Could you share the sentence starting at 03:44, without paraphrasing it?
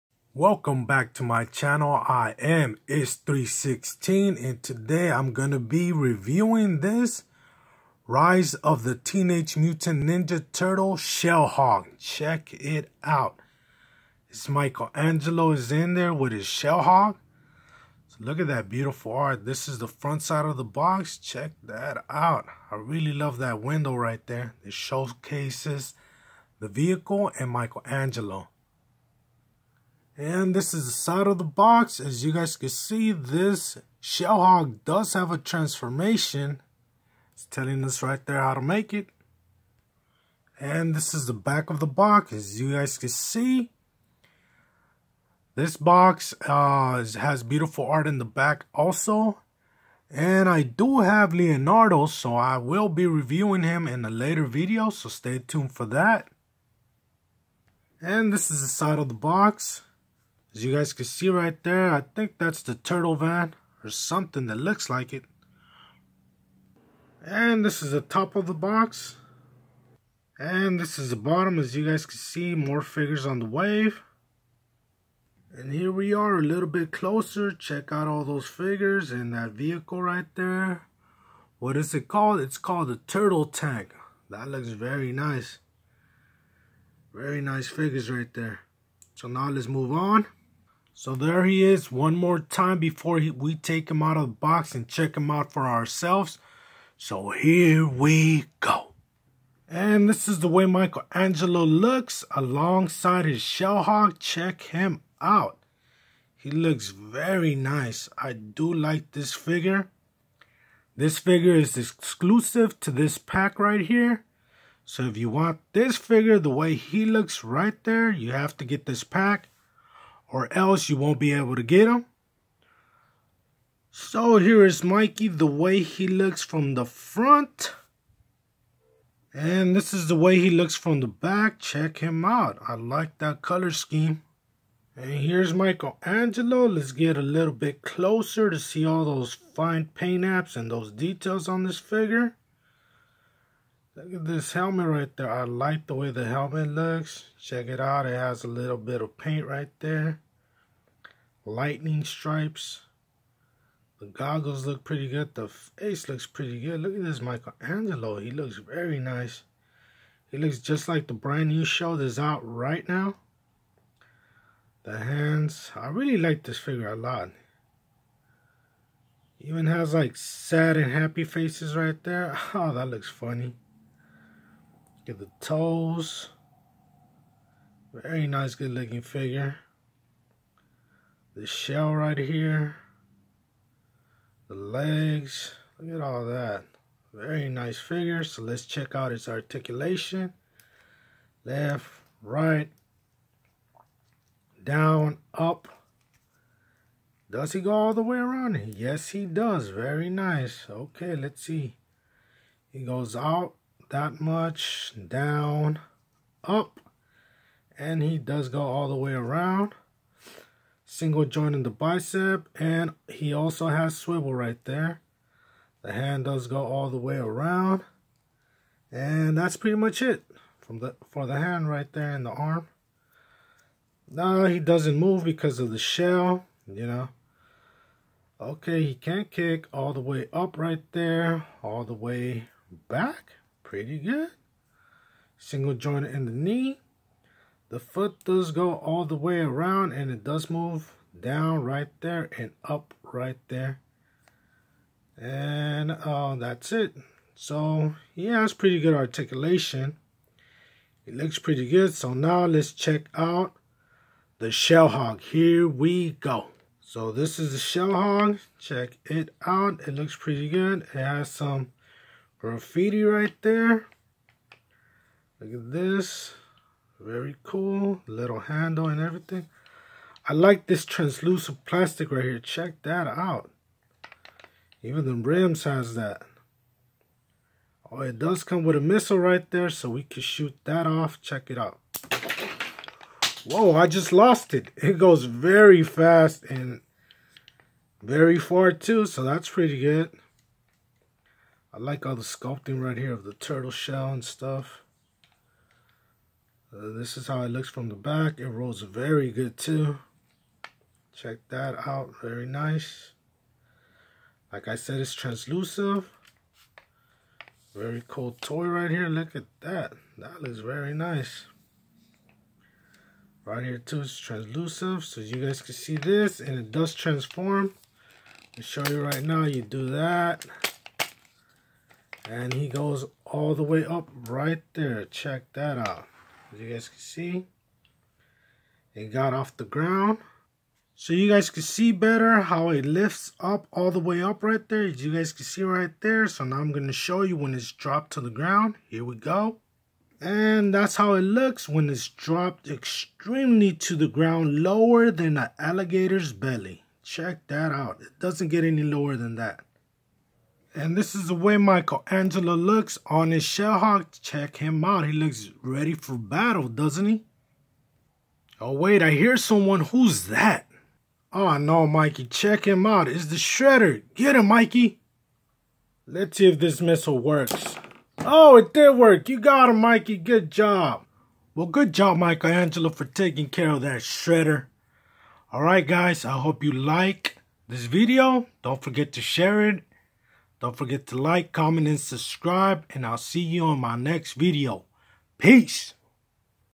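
Now he doesn't move because of the shell, you know.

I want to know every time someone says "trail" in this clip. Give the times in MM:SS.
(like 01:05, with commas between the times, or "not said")
not said.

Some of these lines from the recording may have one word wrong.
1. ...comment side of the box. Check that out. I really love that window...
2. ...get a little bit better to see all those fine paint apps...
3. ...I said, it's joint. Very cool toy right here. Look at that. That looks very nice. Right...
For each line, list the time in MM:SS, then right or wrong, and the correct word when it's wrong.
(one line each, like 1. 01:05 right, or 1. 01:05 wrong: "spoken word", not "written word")
1. 00:19 wrong: "front", not "comment"
2. 02:16 wrong: "closer", not "better"
3. 05:04 wrong: "translucent", not "joint".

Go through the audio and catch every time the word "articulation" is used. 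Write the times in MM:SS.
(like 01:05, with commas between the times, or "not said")
03:09, 04:08.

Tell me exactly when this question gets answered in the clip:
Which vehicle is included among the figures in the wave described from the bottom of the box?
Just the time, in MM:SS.
01:23.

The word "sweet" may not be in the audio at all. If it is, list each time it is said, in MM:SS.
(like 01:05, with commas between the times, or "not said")
not said.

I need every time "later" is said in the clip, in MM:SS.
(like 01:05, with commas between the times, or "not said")
00:54.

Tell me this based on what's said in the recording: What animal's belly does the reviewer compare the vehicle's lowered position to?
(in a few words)
alligator.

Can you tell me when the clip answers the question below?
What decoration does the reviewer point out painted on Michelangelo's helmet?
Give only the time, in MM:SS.
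02:31.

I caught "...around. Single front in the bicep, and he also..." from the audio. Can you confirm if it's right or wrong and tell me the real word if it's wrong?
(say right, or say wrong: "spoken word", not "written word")
wrong: "joint", not "front".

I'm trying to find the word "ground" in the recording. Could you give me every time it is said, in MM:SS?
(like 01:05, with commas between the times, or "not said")
05:29, 05:38, 05:44.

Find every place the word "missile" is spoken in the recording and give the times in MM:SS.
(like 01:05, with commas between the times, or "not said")
04:38, 06:06.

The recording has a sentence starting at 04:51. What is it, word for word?
I like all the sculpting right here of the turtle shell and stuff.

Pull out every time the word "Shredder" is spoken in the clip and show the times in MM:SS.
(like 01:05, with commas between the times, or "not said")
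06:03, 06:14.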